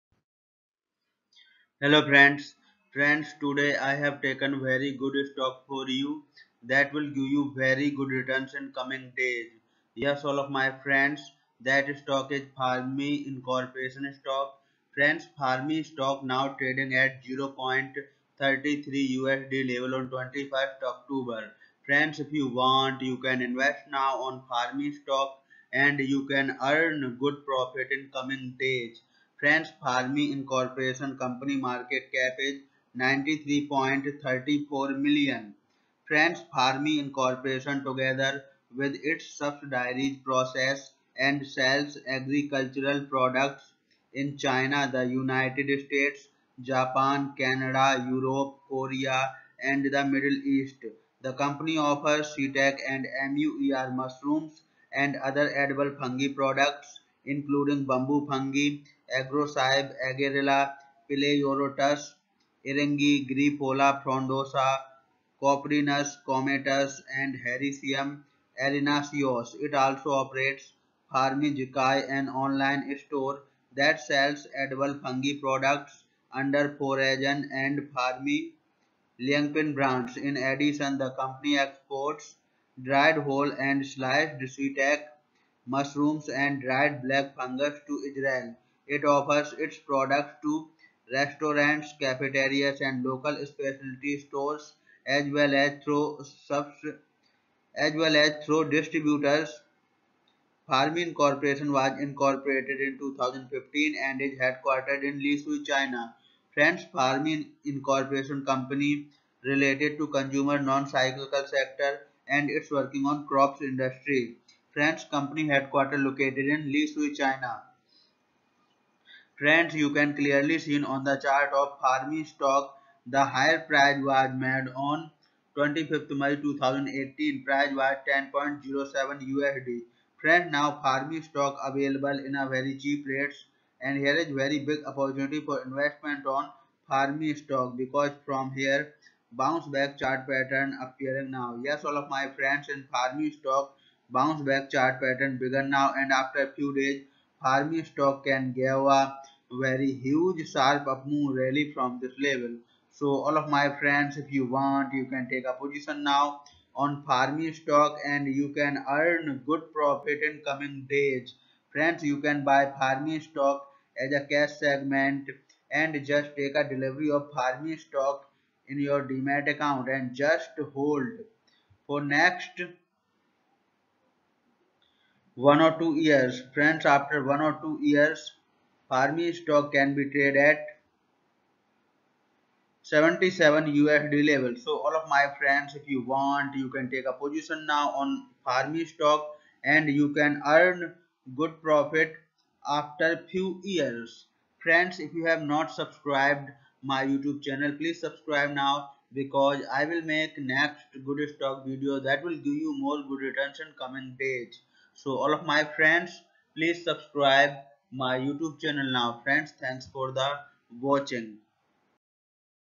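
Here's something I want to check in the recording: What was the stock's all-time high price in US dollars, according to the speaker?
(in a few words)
10.07 USD.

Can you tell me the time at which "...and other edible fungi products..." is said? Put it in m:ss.
0:54.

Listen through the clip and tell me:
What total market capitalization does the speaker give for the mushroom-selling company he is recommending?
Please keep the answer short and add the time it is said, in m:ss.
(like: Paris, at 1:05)
93.34 million, at 0:32.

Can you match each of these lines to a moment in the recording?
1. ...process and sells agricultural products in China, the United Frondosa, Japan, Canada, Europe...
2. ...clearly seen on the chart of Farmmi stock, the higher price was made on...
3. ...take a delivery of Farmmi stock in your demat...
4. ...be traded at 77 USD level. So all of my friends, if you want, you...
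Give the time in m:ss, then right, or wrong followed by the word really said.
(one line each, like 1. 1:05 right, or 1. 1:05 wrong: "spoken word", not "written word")
1. 0:40 wrong: "States", not "Frondosa"
2. 2:00 right
3. 2:46 right
4. 2:59 right.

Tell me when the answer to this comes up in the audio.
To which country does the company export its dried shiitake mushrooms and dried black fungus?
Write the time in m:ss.
1:28.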